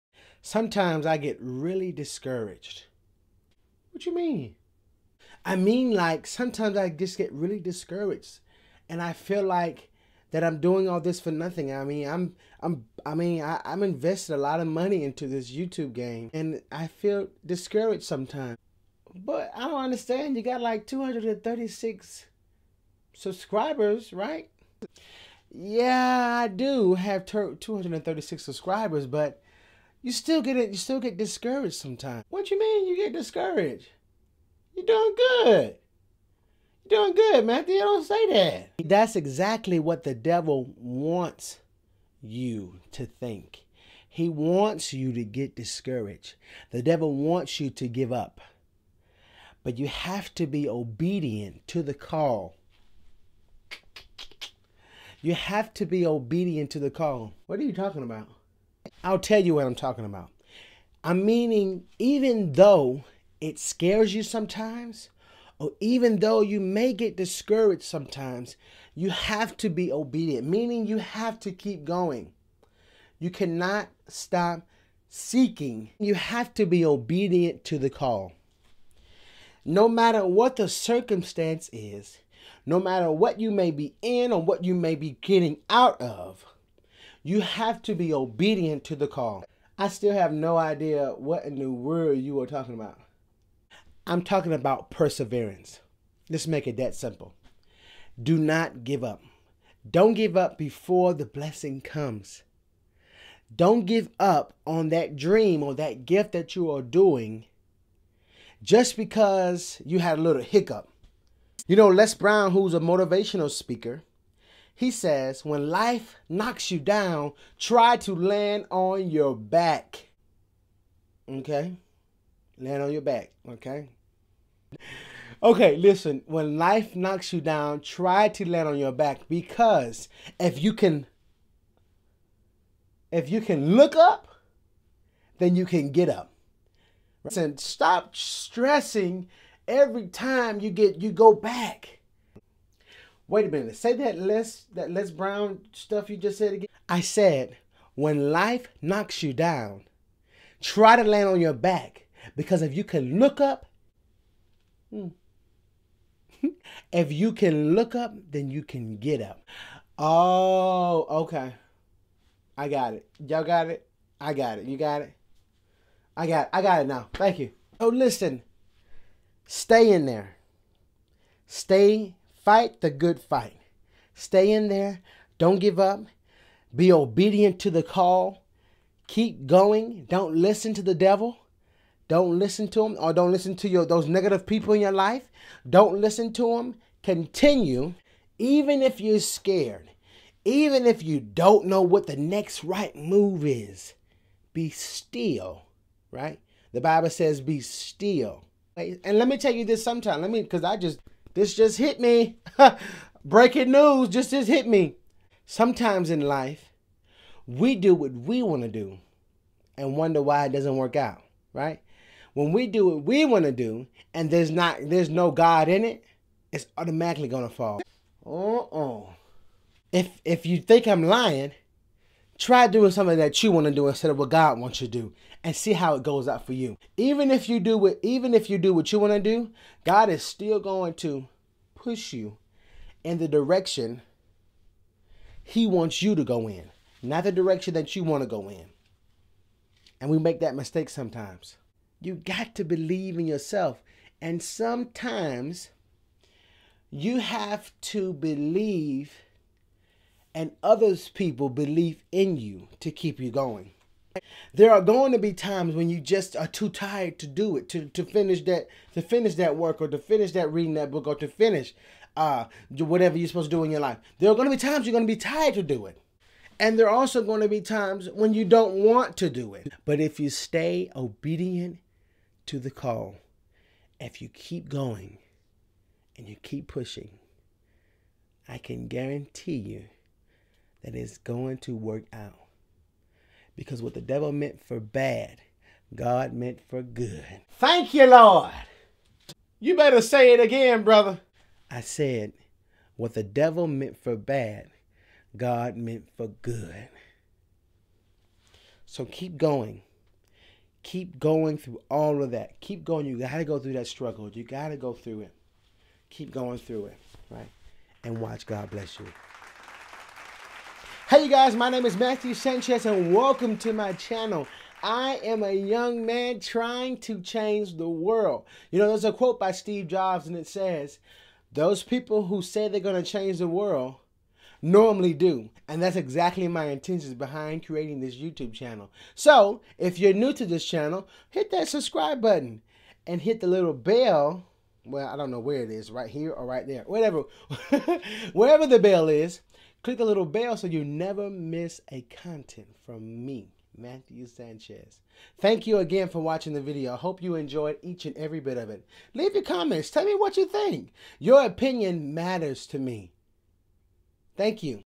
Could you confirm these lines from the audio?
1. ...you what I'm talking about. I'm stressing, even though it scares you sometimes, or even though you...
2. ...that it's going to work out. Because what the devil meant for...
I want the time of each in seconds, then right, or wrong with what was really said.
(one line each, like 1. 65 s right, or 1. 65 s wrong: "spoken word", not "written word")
1. 59 s wrong: "meaning", not "stressing"
2. 280 s right.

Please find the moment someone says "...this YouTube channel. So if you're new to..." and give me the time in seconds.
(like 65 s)
327 s.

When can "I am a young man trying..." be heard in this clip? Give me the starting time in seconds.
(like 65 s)
314 s.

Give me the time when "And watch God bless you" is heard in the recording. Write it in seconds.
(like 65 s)
308 s.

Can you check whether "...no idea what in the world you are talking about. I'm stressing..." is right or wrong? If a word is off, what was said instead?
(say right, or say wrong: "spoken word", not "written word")
wrong: "talking", not "stressing".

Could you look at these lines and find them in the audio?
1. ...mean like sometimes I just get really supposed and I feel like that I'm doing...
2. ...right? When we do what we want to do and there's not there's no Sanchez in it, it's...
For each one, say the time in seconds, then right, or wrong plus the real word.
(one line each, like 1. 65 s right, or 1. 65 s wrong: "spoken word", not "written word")
1. 5 s wrong: "discouraged", not "supposed"
2. 211 s wrong: "God", not "Sanchez".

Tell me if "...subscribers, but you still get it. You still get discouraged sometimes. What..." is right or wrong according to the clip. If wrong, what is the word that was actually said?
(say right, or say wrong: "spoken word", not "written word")
right.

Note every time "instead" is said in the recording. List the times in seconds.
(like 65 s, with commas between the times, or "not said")
223 s.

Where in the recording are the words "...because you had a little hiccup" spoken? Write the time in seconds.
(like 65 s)
108 s.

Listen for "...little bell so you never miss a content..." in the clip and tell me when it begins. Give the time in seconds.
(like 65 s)
340 s.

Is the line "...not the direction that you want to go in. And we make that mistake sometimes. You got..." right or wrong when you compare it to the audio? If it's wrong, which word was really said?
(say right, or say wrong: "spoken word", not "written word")
right.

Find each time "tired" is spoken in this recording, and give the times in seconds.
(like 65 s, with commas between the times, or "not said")
256 s, 265 s.